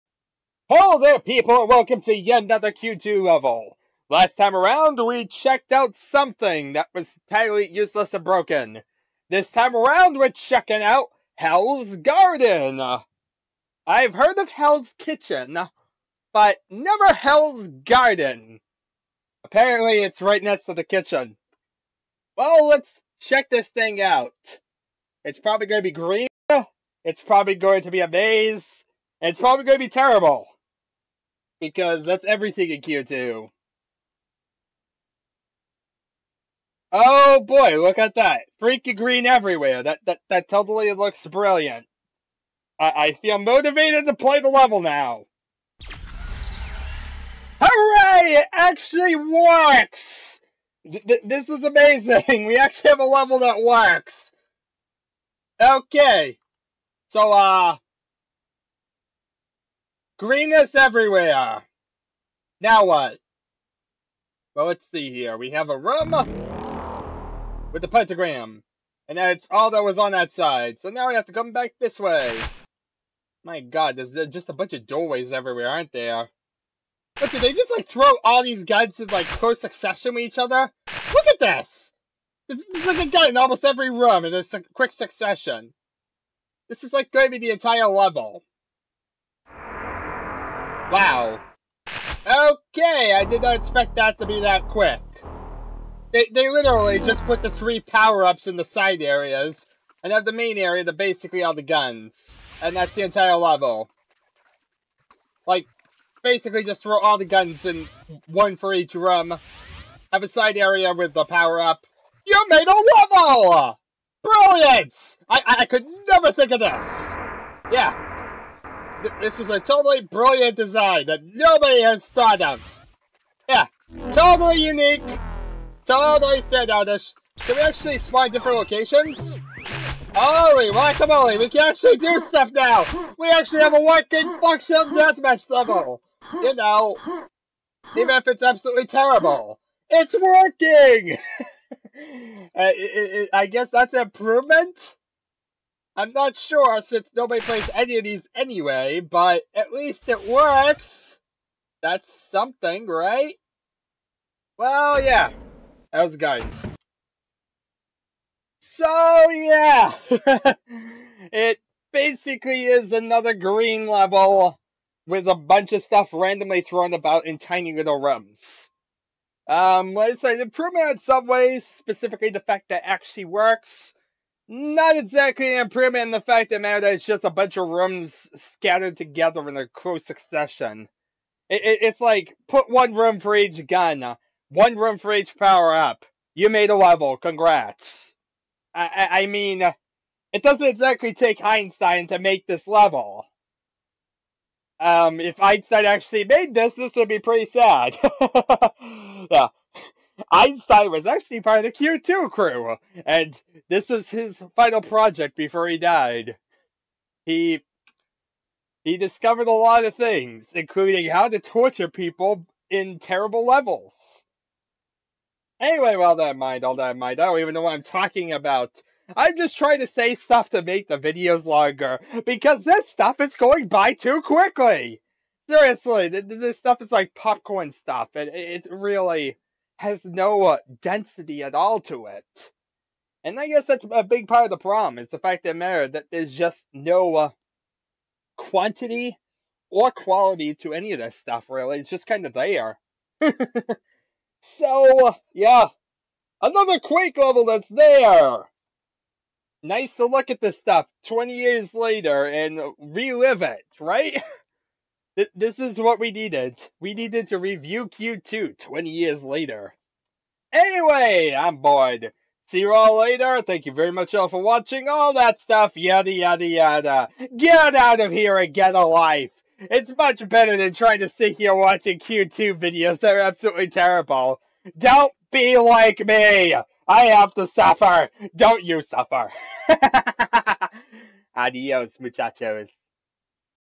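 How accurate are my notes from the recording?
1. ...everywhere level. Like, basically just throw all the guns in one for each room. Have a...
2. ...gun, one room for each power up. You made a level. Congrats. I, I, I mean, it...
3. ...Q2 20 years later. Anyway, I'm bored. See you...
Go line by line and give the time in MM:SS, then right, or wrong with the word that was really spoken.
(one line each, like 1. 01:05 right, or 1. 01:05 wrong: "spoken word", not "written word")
1. 01:43 wrong: "entire", not "everywhere"
2. 03:03 right
3. 04:17 right.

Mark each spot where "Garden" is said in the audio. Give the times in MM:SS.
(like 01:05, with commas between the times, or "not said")
00:11, 00:17.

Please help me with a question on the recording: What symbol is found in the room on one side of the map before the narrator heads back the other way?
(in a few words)
Pentagram.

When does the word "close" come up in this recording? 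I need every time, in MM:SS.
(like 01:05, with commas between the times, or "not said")
01:19, 02:59.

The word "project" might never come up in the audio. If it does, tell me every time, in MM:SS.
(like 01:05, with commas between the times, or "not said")
03:24.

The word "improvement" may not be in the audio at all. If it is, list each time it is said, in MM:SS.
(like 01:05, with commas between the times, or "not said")
02:24, 02:50, 02:55.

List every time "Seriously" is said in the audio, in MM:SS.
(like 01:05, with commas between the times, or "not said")
03:45.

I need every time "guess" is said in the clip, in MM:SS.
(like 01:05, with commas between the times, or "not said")
02:23, 03:53.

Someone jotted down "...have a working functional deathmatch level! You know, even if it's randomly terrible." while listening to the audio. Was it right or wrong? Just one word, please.
wrong.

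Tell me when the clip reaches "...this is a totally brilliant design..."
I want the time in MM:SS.
01:59.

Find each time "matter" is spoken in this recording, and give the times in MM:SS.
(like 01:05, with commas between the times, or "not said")
02:56, 03:55.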